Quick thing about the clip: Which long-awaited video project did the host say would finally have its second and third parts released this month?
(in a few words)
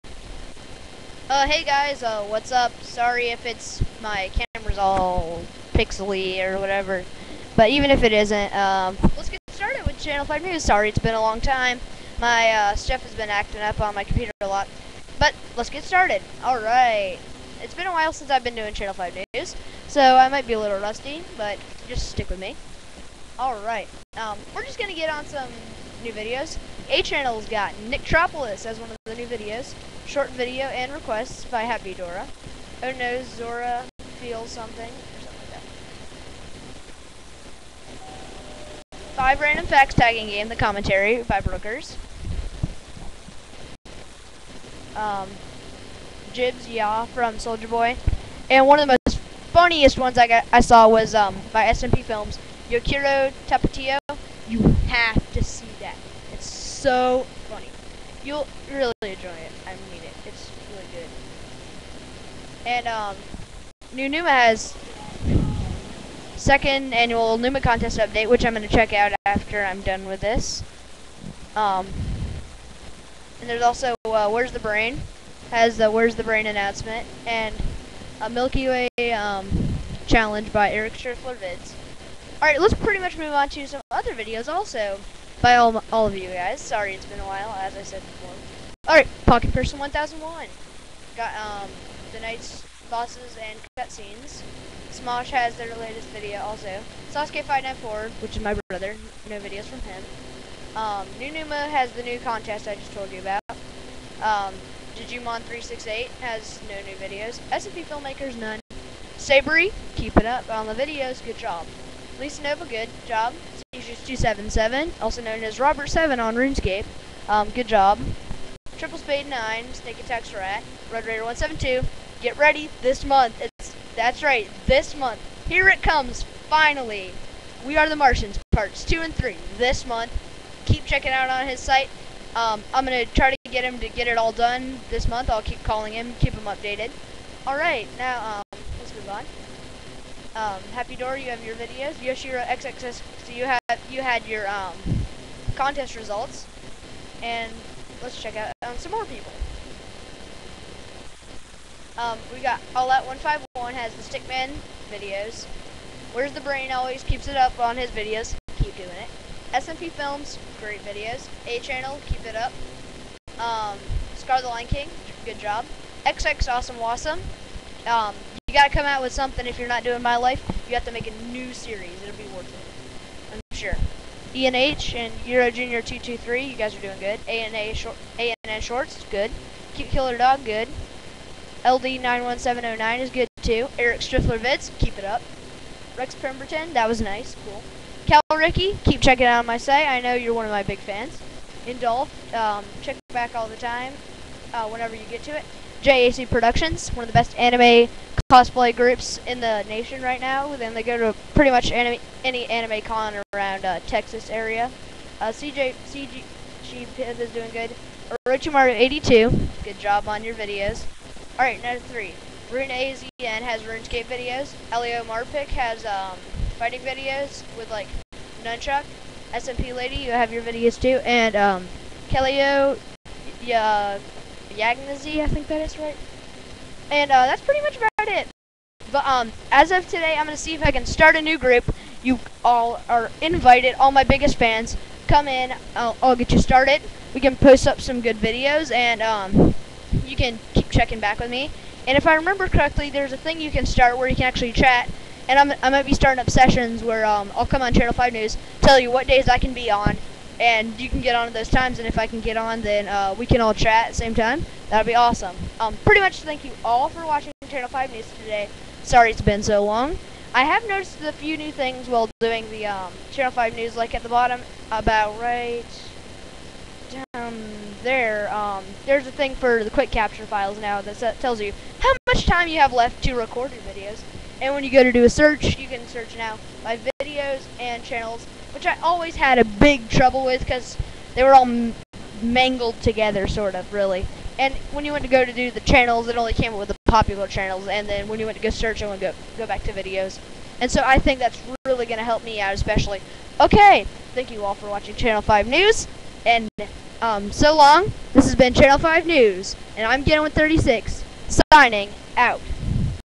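We Are the Martians.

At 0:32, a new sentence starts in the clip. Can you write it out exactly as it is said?
Oh no, Zora feels something, or something like that.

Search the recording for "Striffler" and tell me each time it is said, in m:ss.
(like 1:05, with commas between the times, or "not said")
1:20, 3:04.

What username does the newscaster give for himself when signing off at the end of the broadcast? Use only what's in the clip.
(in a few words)
Ganon136.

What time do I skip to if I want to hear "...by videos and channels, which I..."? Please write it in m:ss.
4:36.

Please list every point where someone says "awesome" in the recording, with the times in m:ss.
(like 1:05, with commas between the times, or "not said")
2:46, 4:14.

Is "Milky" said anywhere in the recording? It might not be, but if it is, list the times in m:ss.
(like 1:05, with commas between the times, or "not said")
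1:18.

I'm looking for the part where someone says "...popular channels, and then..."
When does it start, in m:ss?
4:46.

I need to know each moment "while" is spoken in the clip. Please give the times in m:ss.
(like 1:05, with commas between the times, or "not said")
0:17, 1:27, 4:21.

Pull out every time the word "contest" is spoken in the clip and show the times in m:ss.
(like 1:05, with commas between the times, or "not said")
1:07, 1:42, 2:25.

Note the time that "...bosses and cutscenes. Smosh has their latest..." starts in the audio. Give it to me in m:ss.
1:32.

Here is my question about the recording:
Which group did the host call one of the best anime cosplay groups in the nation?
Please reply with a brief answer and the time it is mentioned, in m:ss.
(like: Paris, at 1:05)
JAC Productions, at 3:15.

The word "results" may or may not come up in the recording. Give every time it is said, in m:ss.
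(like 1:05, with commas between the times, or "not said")
2:25.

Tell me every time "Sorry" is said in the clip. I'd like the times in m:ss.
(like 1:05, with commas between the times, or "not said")
0:02, 0:10, 1:26, 4:18.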